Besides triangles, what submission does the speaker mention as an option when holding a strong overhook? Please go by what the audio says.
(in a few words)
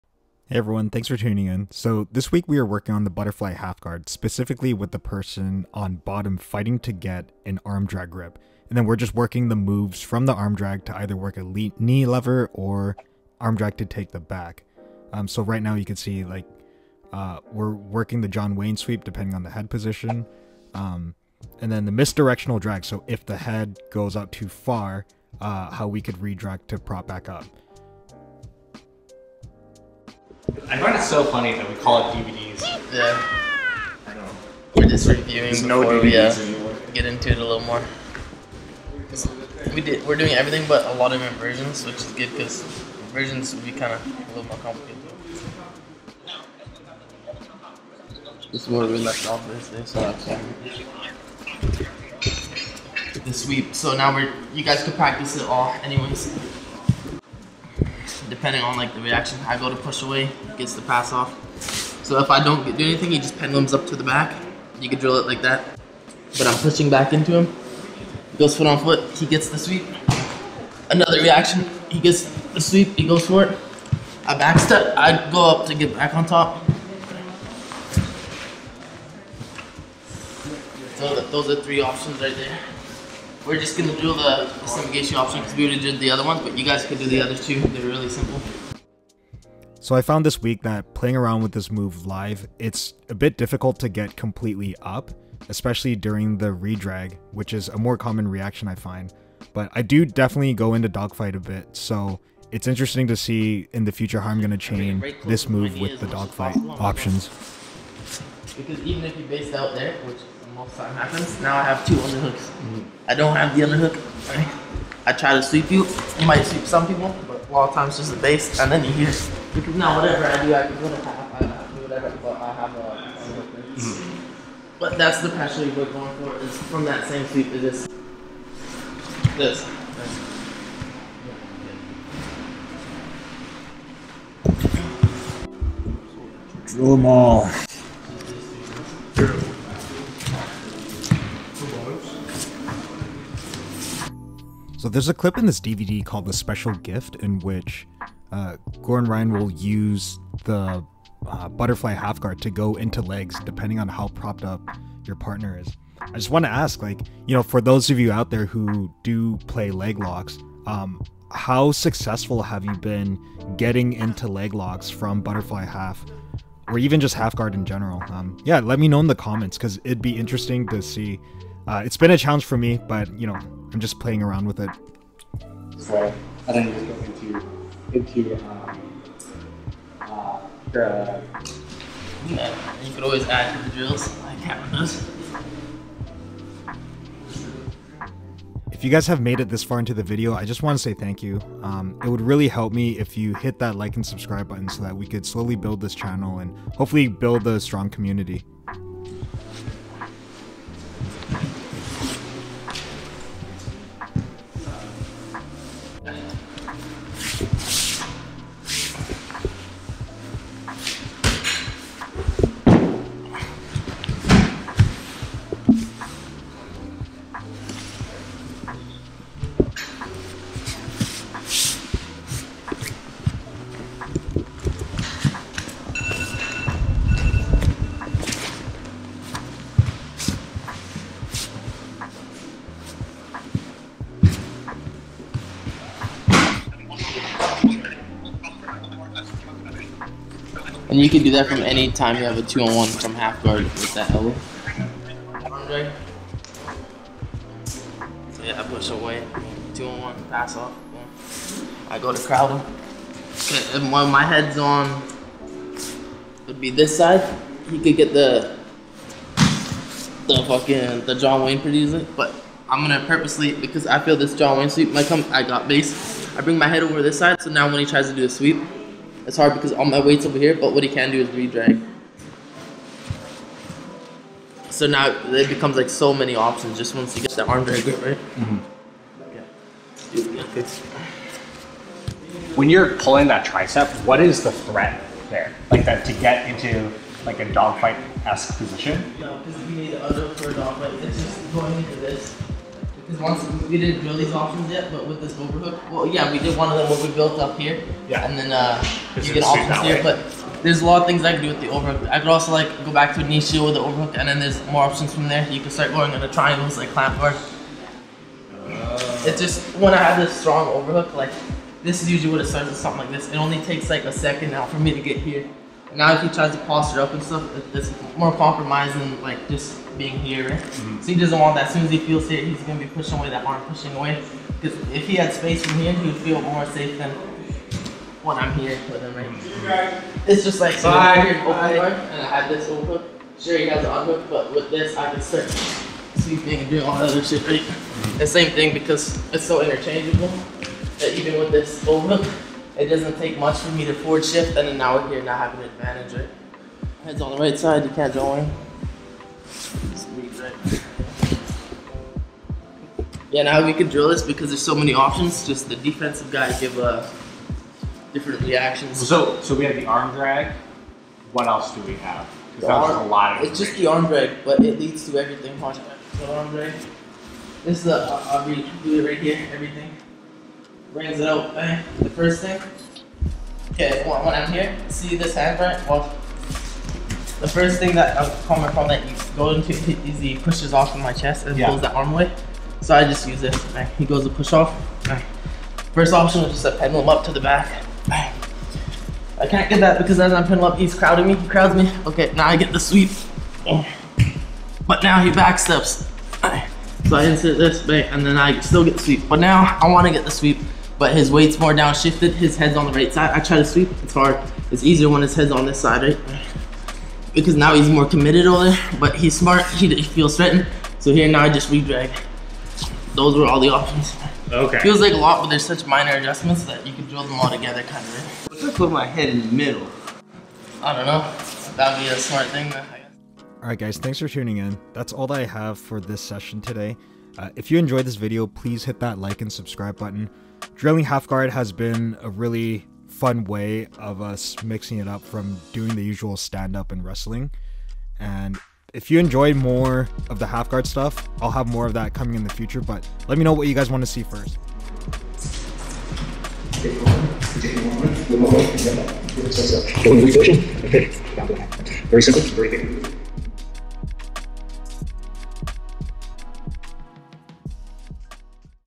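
clamp bar.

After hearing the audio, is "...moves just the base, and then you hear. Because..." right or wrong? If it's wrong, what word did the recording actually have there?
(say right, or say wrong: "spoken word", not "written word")
wrong: "times", not "moves".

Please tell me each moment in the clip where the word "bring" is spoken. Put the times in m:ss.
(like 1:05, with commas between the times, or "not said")
4:26, 6:10.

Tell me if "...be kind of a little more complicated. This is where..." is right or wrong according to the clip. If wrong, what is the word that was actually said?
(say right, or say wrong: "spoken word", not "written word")
right.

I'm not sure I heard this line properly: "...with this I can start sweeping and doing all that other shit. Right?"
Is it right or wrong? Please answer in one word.
right.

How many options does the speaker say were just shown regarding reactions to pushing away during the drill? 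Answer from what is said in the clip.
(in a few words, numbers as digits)
3.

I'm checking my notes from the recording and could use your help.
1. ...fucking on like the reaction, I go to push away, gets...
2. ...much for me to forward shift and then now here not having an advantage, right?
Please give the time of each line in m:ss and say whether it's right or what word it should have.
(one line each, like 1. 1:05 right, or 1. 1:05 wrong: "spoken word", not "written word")
1. 0:58 wrong: "depending", not "fucking"
2. 5:43 right.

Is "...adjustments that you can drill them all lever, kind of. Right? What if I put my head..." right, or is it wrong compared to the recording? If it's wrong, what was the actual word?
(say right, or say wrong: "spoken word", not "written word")
wrong: "together", not "lever".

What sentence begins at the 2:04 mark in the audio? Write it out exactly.
But that's the pressure you're going for.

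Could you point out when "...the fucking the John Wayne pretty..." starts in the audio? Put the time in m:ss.
4:20.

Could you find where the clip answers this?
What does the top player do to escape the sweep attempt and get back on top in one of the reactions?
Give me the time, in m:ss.
1:14.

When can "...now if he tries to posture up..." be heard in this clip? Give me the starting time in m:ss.
5:15.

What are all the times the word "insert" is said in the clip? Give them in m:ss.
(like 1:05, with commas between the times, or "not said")
6:37.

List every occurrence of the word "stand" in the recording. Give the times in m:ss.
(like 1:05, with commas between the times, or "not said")
7:16.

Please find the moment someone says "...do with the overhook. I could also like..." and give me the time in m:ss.
5:01.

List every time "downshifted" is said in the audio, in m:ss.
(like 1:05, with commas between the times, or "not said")
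6:41.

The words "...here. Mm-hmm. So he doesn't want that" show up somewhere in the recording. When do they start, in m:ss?
5:20.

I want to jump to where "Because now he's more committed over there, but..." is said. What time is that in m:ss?
6:47.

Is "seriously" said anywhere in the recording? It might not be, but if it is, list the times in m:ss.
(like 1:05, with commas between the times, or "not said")
not said.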